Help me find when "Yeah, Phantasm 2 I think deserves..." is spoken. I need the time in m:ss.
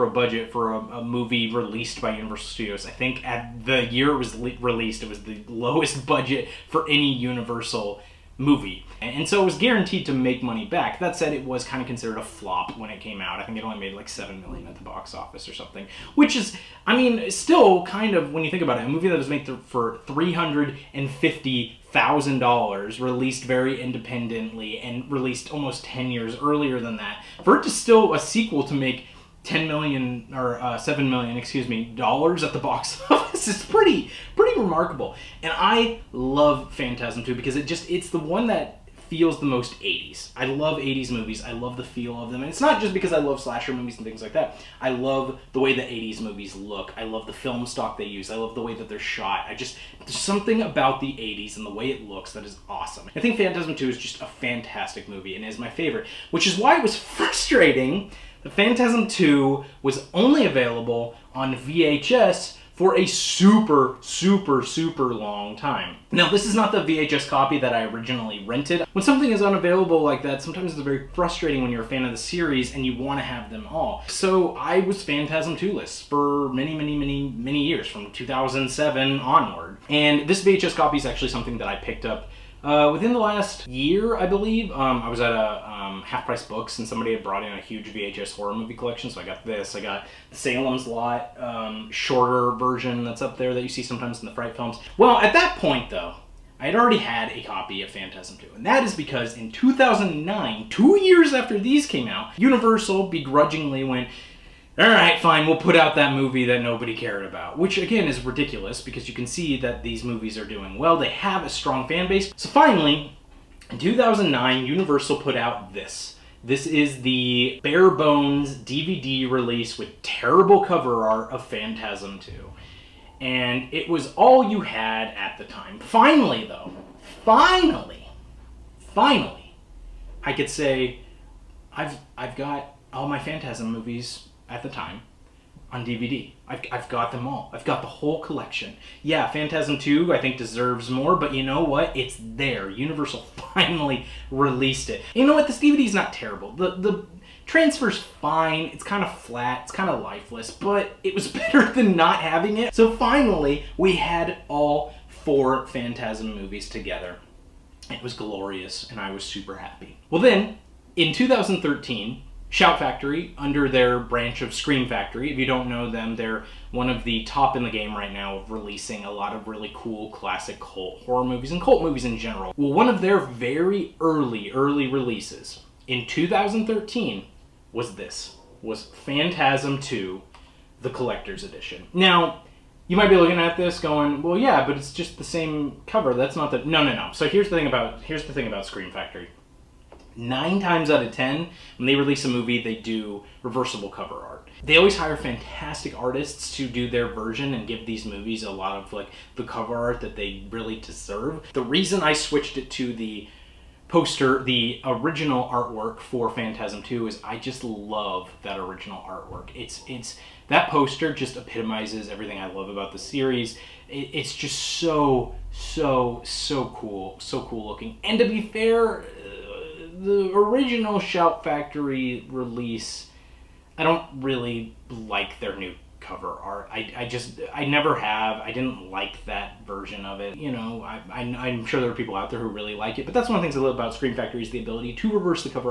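2:19.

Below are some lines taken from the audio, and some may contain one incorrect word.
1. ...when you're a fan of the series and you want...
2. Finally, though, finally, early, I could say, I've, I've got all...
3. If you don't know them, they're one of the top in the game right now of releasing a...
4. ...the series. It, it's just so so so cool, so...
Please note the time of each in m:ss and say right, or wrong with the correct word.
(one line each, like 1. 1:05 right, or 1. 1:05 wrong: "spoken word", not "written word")
1. 1:11 right
2. 2:05 wrong: "finally", not "early"
3. 2:45 right
4. 3:32 right.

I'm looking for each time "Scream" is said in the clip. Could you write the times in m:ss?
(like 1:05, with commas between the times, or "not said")
2:44, 3:08, 3:53.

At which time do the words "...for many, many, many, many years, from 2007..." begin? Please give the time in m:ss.
1:15.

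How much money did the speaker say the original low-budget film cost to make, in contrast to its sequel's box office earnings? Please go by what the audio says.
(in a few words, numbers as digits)
$350,000.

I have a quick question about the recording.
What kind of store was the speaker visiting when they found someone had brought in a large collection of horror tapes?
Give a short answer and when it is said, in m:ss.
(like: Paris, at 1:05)
Half Price Books, at 1:26.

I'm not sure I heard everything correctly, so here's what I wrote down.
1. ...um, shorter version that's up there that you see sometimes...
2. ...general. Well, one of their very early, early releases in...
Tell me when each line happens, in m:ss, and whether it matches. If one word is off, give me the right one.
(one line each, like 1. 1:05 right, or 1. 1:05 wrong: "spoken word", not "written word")
1. 1:31 right
2. 2:52 right.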